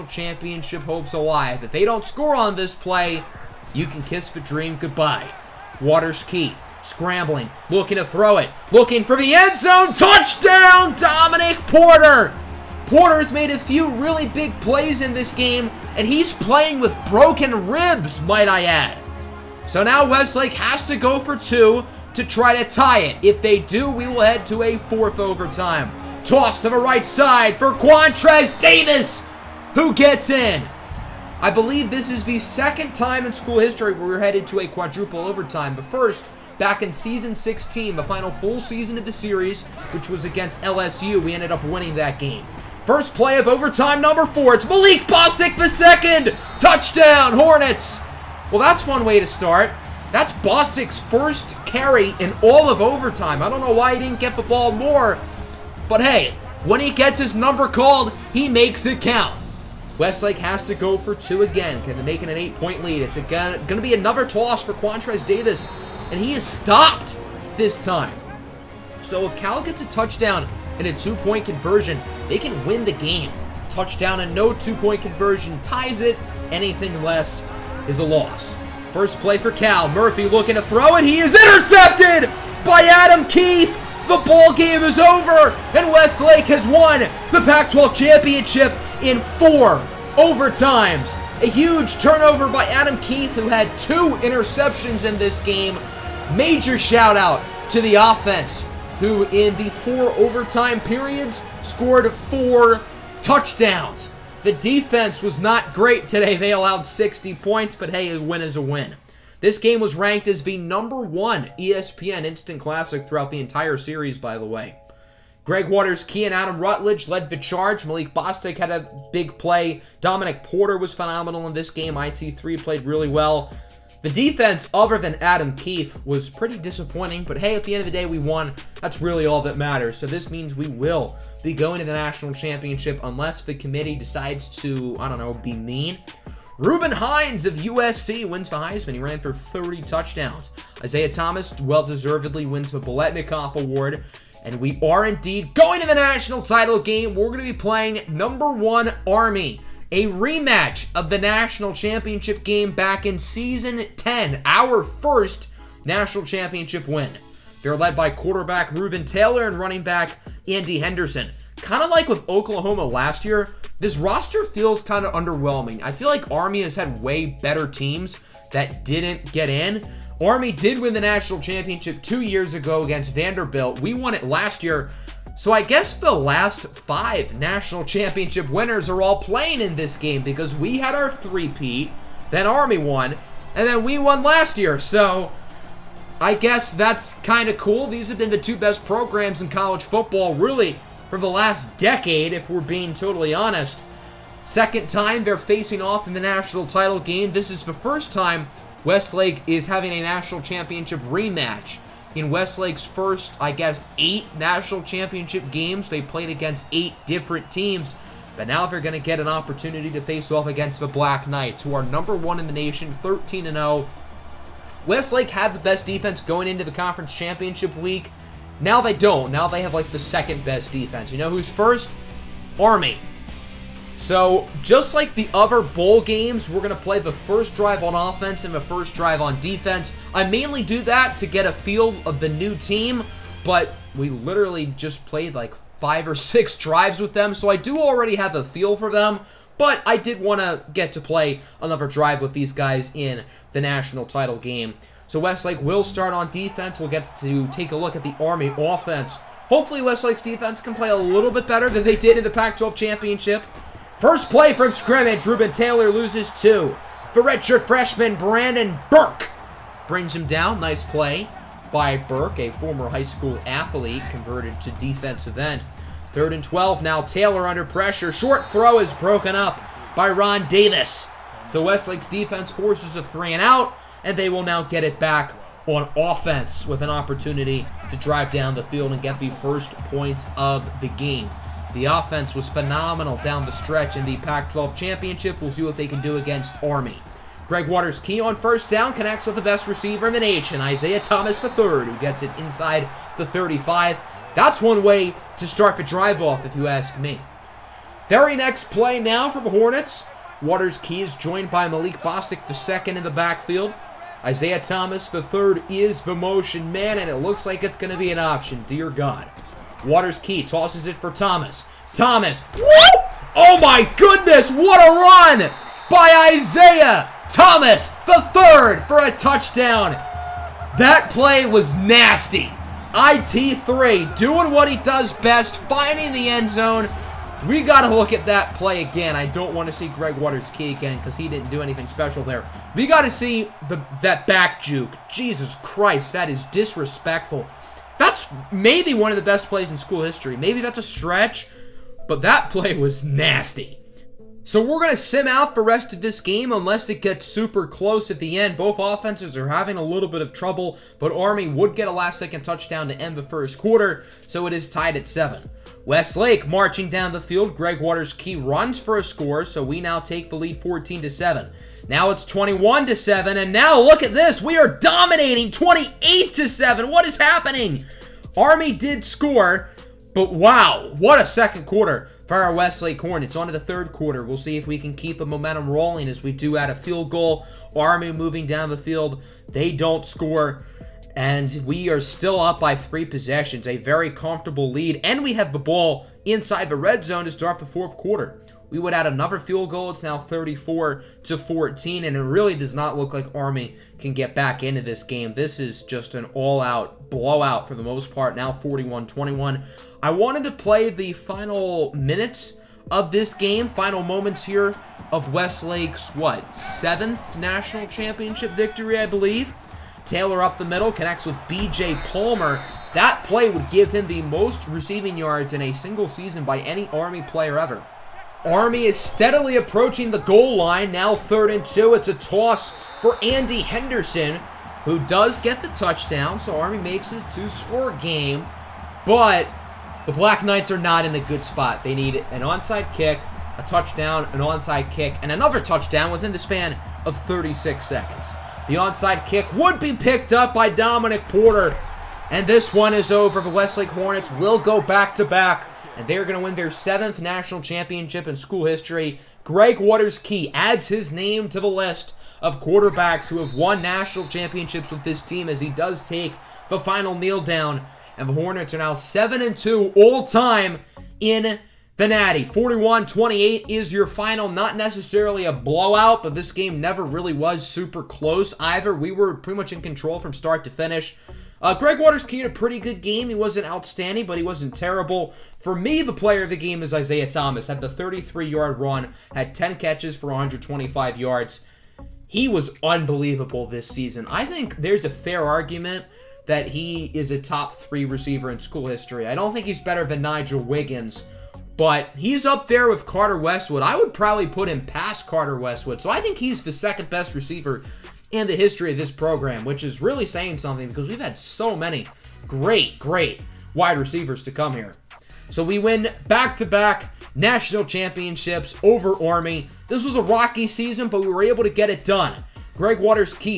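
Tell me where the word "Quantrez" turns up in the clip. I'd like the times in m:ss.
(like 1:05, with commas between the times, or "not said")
0:27, 1:04.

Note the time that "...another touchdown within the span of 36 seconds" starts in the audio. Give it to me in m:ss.
7:15.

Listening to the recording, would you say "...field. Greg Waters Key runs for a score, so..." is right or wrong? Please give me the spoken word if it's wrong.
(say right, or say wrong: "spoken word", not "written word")
right.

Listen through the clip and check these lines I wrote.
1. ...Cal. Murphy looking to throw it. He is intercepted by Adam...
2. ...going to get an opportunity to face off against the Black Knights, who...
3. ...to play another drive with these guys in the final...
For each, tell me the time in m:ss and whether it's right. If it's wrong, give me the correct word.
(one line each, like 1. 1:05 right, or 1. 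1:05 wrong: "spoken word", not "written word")
1. 1:19 right
2. 3:28 right
3. 4:00 wrong: "national", not "final".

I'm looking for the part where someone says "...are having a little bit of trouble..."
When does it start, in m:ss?
5:49.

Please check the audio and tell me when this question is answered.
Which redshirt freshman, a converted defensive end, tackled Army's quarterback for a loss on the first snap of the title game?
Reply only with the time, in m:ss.
4:18.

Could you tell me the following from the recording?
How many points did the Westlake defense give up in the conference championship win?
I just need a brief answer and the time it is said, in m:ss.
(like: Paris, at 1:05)
60, at 1:46.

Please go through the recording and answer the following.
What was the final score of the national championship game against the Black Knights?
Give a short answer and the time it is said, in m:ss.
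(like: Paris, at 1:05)
41-28, at 7:42.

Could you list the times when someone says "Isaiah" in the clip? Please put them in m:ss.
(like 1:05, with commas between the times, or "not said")
2:20, 4:50, 5:04, 5:16, 7:56.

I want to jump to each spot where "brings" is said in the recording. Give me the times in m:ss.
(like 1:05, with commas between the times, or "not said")
4:19.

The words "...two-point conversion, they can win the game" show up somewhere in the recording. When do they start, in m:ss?
1:10.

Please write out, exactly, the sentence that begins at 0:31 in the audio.
I believe this is the second time in school history where we're headed to a quadruple overtime.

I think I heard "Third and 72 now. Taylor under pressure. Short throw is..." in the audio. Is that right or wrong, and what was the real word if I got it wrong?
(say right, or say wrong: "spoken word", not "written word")
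wrong: "12", not "72".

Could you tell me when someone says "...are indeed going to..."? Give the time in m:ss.
2:24.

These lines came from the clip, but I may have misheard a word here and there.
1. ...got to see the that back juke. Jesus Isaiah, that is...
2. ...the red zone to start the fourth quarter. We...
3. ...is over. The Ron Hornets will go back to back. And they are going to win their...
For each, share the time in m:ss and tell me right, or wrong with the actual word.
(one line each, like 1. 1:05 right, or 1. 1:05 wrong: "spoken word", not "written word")
1. 5:32 wrong: "Christ", not "Isaiah"
2. 6:26 right
3. 7:22 wrong: "Westlake", not "Ron".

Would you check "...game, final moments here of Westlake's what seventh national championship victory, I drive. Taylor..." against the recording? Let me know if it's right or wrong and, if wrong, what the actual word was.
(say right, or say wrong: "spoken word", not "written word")
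wrong: "believe", not "drive".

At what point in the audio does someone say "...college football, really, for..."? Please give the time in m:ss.
3:09.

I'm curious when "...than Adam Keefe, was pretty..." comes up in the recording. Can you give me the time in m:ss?
2:04.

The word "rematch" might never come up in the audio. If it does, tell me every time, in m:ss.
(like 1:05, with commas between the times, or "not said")
2:30, 3:21.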